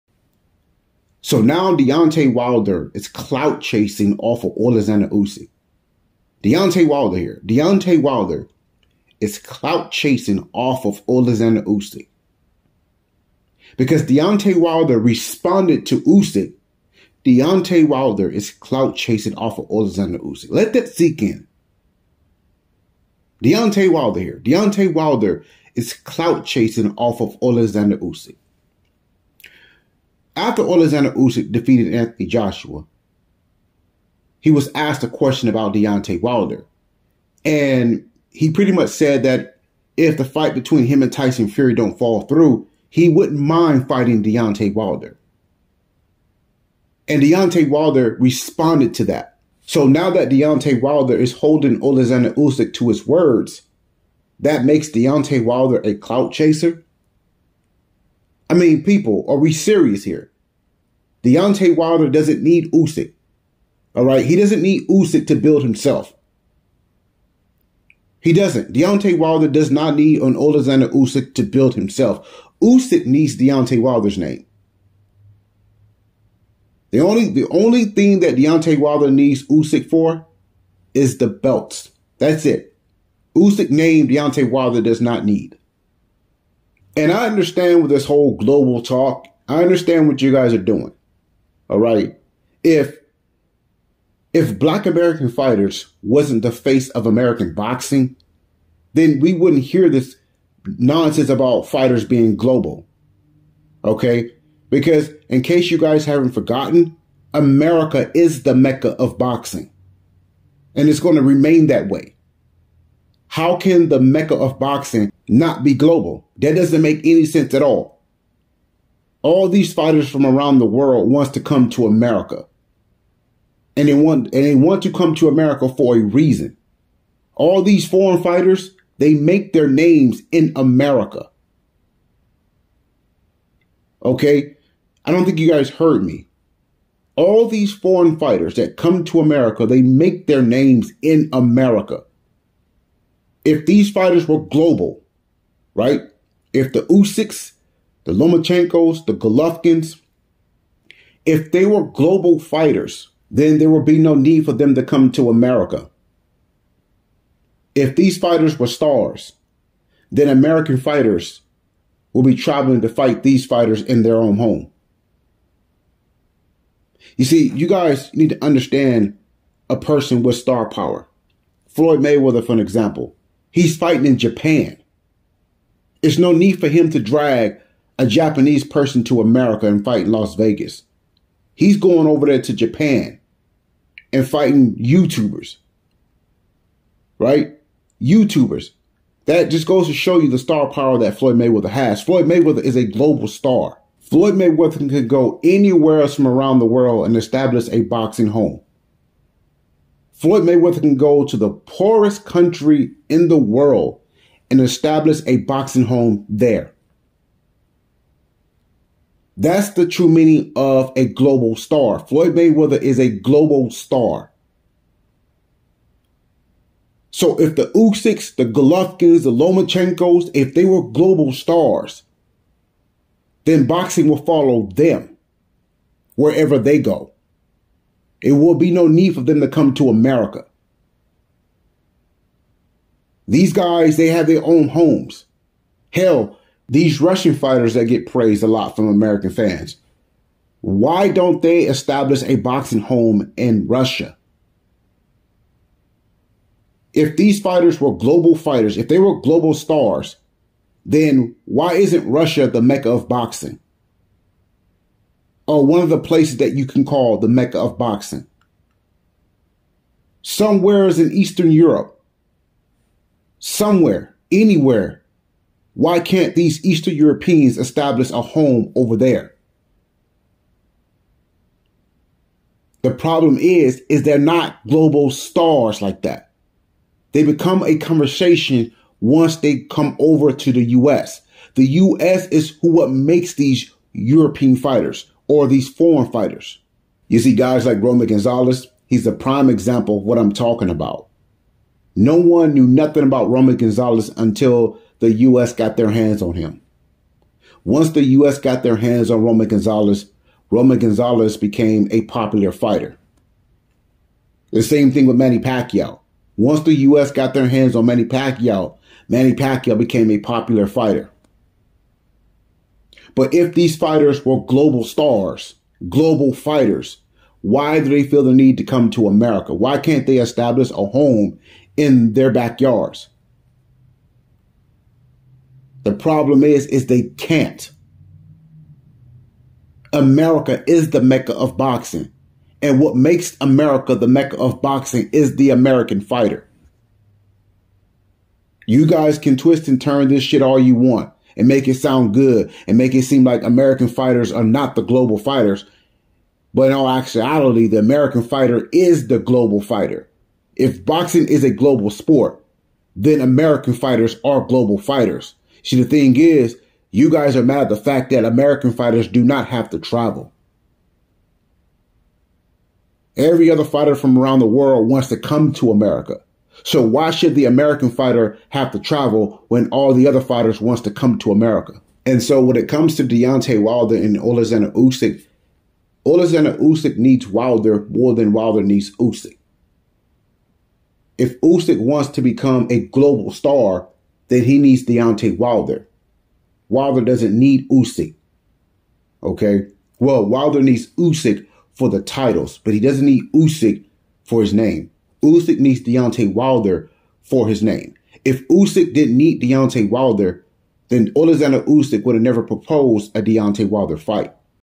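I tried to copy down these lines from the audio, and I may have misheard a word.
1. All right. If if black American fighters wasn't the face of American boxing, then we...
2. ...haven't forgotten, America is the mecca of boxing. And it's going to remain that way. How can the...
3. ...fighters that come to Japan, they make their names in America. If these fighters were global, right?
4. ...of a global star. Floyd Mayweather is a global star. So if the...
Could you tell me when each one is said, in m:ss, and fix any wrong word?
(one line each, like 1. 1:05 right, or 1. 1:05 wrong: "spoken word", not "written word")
1. 1:31 right
2. 1:46 right
3. 2:18 wrong: "America", not "Japan"
4. 3:30 right.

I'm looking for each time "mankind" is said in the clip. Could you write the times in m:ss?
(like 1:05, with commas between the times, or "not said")
not said.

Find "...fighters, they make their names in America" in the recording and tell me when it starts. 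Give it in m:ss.
2:08.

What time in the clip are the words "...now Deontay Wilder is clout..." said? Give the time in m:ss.
0:01.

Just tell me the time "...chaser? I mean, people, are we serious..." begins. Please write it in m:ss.
0:56.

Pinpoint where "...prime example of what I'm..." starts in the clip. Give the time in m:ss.
4:49.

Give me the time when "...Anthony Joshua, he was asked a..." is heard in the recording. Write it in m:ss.
0:31.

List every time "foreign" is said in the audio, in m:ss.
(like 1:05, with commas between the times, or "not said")
2:07, 2:17, 4:45.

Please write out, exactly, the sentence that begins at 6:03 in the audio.
Every other fighter from around the world wants to come to America.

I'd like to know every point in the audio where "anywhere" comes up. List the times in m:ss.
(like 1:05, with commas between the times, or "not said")
3:15, 4:24.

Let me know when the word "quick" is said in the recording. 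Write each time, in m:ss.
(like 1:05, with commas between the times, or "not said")
not said.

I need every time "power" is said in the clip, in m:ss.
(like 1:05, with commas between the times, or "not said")
2:50, 3:10.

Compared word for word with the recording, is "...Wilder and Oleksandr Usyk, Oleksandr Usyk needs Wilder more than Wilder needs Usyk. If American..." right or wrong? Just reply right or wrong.
wrong.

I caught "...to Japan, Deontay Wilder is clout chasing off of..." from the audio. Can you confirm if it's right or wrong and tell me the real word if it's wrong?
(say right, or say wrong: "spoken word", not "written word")
wrong: "Usyk", not "Japan".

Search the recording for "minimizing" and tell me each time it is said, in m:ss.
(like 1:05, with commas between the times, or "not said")
not said.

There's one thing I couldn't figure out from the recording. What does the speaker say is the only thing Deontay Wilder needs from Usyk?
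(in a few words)
The belts.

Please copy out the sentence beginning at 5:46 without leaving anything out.
But in all actuality, the American fighter is the global fighter.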